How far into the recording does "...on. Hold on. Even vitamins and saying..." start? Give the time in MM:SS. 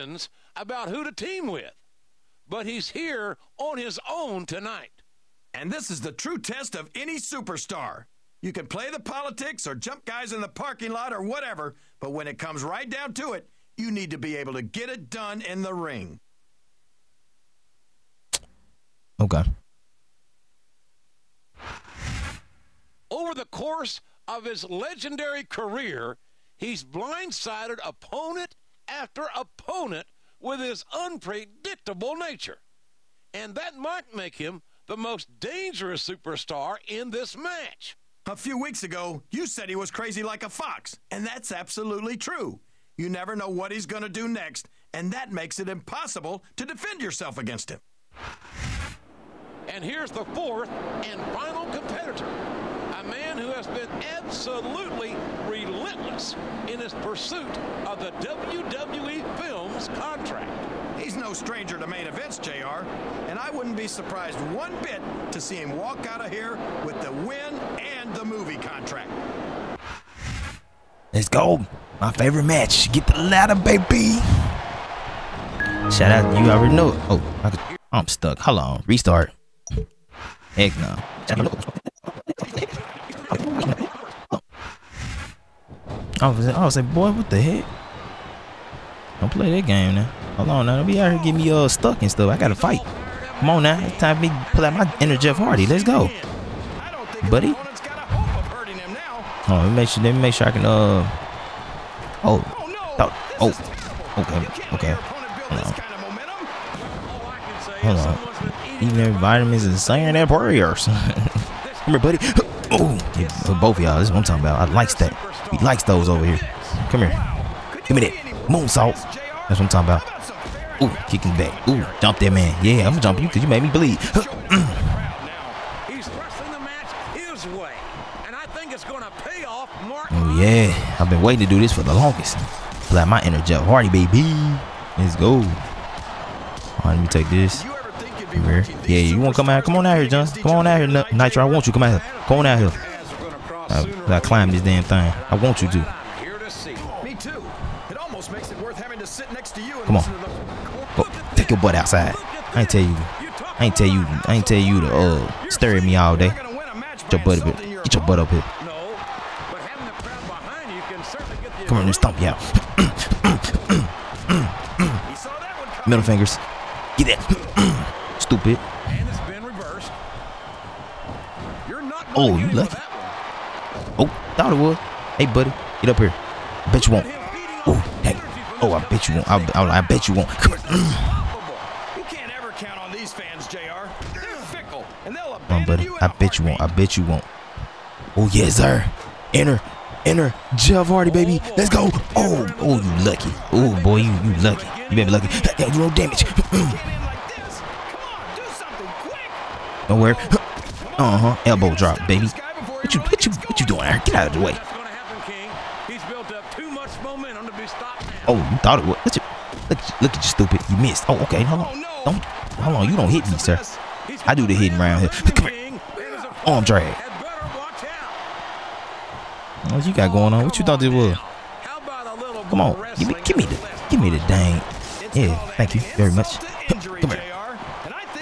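01:47.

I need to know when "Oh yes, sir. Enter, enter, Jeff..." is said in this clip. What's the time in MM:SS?
03:08.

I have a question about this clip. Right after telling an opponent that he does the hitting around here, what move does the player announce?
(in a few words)
Arm drag.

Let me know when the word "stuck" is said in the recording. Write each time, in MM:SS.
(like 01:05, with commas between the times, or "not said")
01:18, 01:31.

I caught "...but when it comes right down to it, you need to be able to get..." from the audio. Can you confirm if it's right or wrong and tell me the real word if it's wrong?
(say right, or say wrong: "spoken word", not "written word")
right.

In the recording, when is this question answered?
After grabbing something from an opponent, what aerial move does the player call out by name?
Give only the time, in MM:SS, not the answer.
01:58.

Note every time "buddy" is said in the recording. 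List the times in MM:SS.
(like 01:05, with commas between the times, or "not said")
01:37, 01:51, 02:55, 03:05.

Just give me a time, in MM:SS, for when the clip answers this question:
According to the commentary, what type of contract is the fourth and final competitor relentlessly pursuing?
00:58.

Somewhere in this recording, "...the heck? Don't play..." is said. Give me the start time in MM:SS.
01:27.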